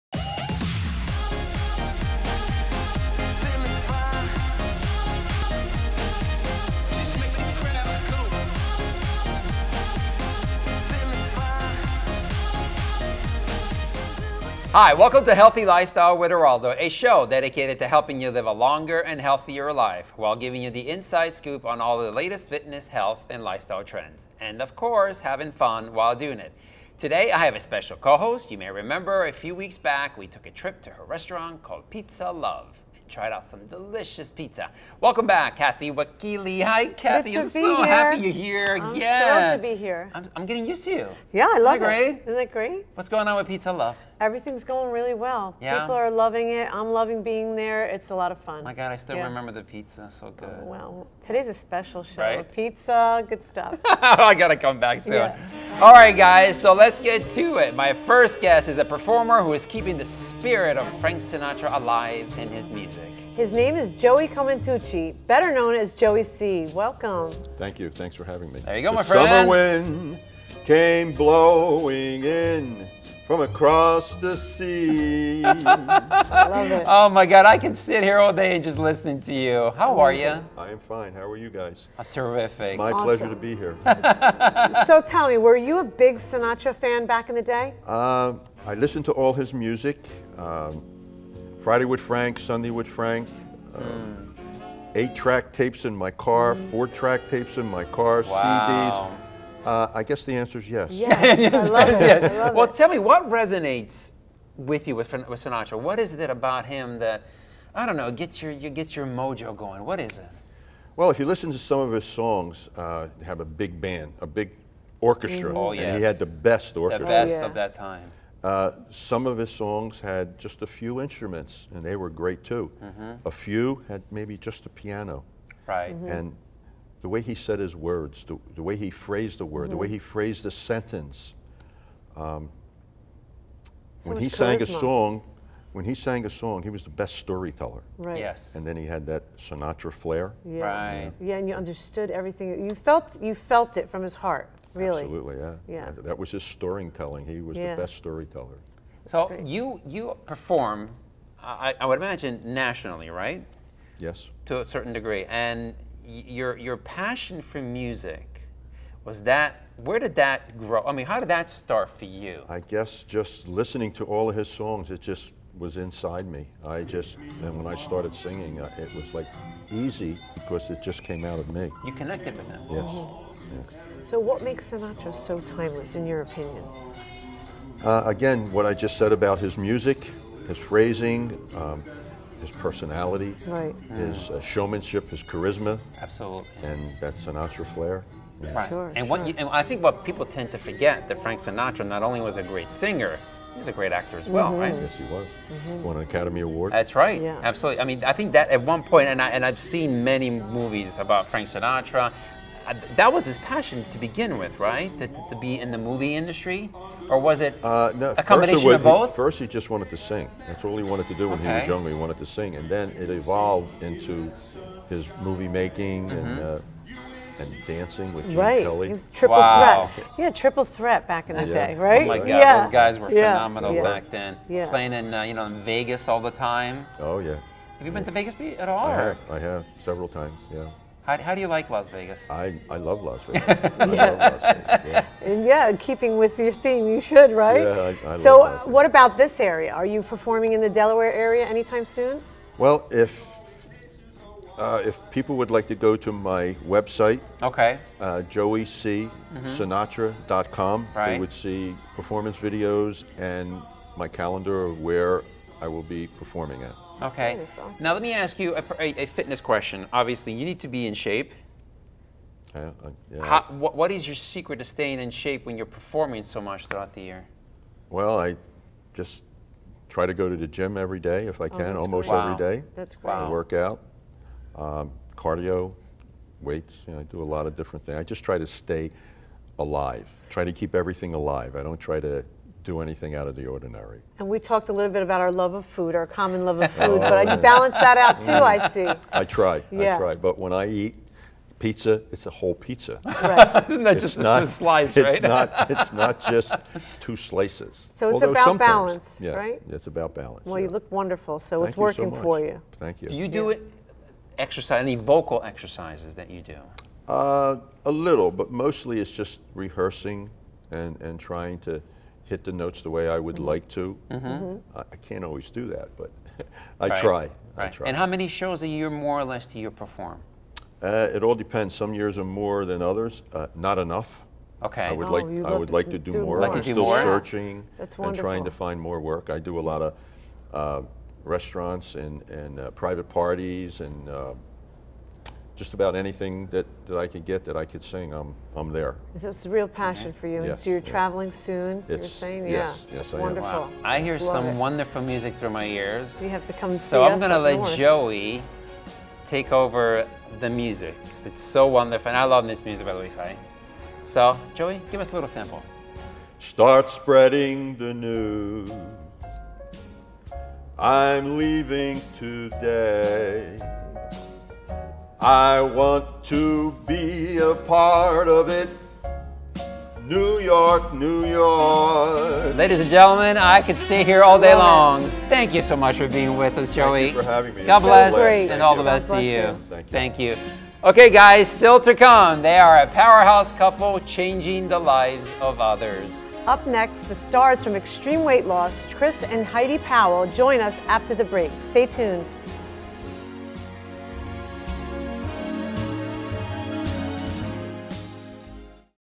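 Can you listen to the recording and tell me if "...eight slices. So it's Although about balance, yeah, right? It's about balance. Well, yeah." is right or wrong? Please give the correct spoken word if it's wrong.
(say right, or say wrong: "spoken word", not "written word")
wrong: "two", not "eight".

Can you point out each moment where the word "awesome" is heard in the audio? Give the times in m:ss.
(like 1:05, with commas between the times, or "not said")
1:22, 4:17.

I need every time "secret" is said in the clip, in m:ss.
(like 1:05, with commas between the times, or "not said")
4:24.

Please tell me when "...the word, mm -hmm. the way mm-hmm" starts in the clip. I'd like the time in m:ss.
2:09.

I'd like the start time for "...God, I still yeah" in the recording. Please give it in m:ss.
0:48.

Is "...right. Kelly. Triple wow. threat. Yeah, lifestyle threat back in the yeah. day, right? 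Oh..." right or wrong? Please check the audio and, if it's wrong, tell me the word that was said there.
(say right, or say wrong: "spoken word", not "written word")
wrong: "triple", not "lifestyle".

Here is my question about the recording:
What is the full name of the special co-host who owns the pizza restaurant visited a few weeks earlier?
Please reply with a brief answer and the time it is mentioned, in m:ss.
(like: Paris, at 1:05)
Kathy Wakile, at 0:35.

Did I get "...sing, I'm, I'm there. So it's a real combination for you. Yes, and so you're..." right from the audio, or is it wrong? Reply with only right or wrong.
wrong.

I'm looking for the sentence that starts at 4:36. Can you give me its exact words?
You know, I do a lot of different things.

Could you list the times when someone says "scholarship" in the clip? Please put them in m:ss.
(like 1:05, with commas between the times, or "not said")
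not said.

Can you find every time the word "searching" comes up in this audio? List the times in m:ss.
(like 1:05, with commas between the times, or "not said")
5:27.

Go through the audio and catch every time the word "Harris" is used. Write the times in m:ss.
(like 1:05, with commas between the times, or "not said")
not said.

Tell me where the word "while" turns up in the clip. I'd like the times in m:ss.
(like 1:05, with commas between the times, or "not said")
0:20, 0:25.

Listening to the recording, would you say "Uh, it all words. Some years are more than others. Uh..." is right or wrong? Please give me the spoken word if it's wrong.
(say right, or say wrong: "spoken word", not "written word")
wrong: "depends", not "words".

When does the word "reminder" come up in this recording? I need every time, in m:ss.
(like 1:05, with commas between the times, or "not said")
not said.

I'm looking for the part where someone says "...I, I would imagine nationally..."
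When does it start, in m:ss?
2:31.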